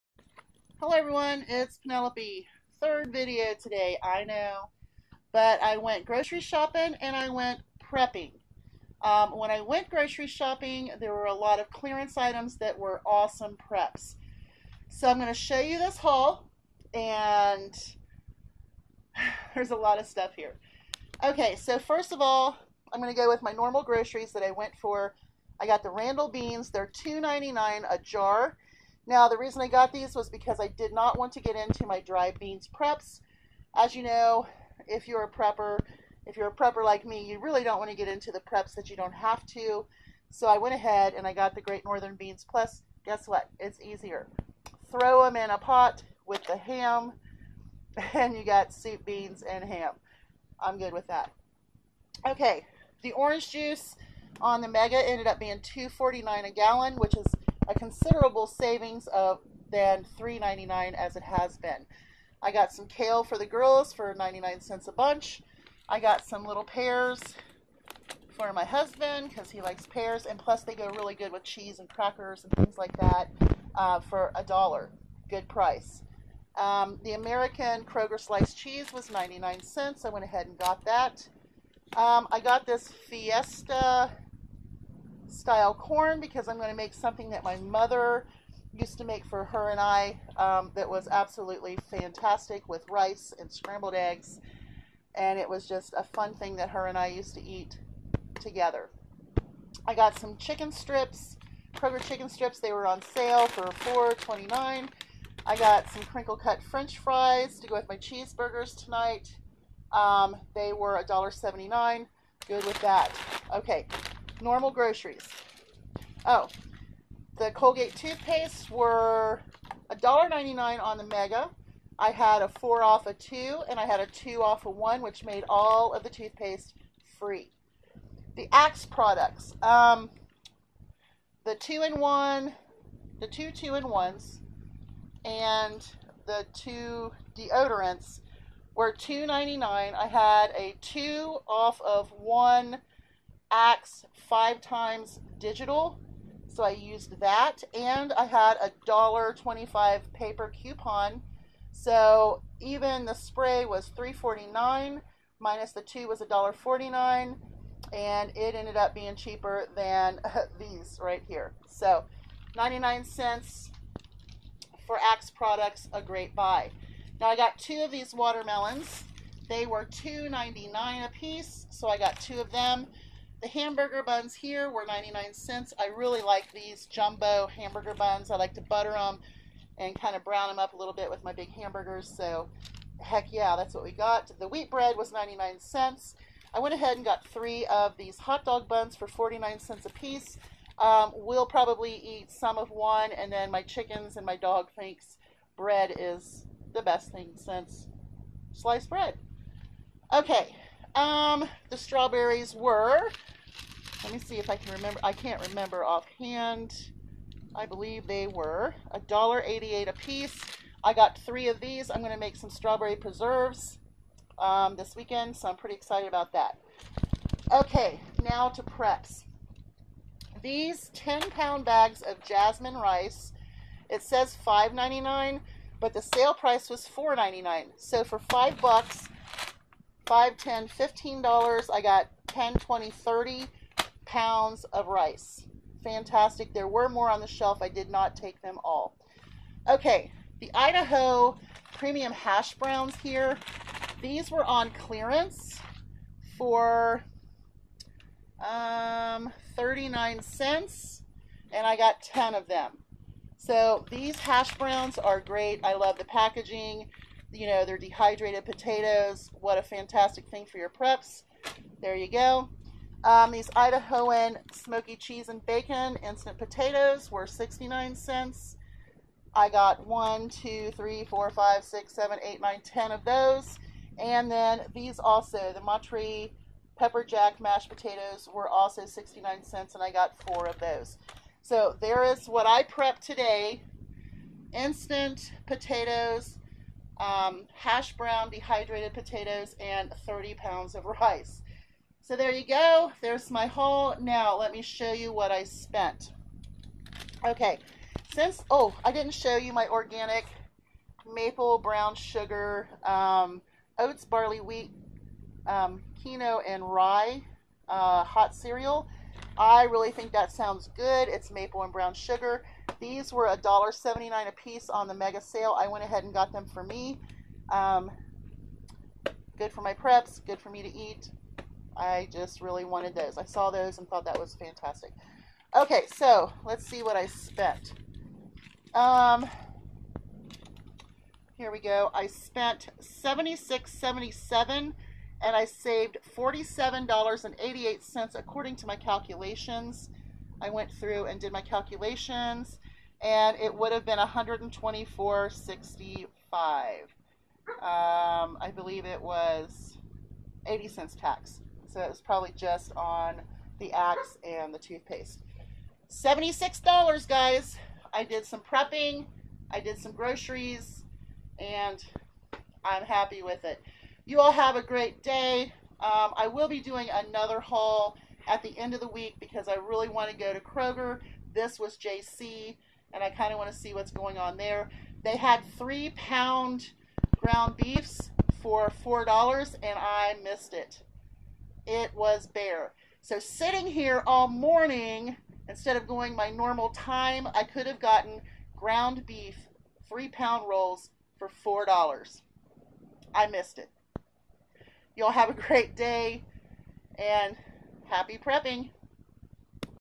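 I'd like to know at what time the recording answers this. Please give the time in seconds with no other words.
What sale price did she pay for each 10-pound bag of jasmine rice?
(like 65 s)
226 s.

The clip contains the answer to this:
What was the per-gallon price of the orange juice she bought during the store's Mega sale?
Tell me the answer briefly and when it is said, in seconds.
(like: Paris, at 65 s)
$2.49, at 55 s.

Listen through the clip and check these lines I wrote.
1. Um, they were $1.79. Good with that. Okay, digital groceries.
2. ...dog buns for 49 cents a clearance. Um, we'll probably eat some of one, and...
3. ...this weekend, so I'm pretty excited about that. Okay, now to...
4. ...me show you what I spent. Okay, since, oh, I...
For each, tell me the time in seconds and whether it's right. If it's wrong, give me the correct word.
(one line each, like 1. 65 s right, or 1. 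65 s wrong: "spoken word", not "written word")
1. 109 s wrong: "normal", not "digital"
2. 188 s wrong: "piece", not "clearance"
3. 214 s right
4. 294 s right.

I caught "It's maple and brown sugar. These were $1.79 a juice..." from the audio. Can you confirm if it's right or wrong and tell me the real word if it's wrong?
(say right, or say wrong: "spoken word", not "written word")
wrong: "piece", not "juice".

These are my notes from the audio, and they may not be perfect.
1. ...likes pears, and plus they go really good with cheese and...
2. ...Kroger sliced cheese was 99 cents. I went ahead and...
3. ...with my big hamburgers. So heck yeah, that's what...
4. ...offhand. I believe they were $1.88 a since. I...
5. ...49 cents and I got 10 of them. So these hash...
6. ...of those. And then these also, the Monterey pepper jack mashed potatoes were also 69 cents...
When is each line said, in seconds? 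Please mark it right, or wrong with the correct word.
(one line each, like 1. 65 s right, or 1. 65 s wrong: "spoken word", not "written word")
1. 69 s right
2. 77 s right
3. 181 s right
4. 205 s wrong: "piece", not "since"
5. 249 s wrong: "39", not "49"
6. 272 s right.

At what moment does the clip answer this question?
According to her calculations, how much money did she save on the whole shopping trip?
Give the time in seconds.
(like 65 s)
336 s.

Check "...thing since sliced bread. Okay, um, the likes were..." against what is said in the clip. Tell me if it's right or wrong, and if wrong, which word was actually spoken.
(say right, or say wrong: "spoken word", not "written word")
wrong: "strawberries", not "likes".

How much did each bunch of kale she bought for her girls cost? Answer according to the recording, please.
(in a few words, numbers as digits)
99 cents.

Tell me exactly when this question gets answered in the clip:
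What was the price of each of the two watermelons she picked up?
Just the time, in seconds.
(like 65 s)
169 s.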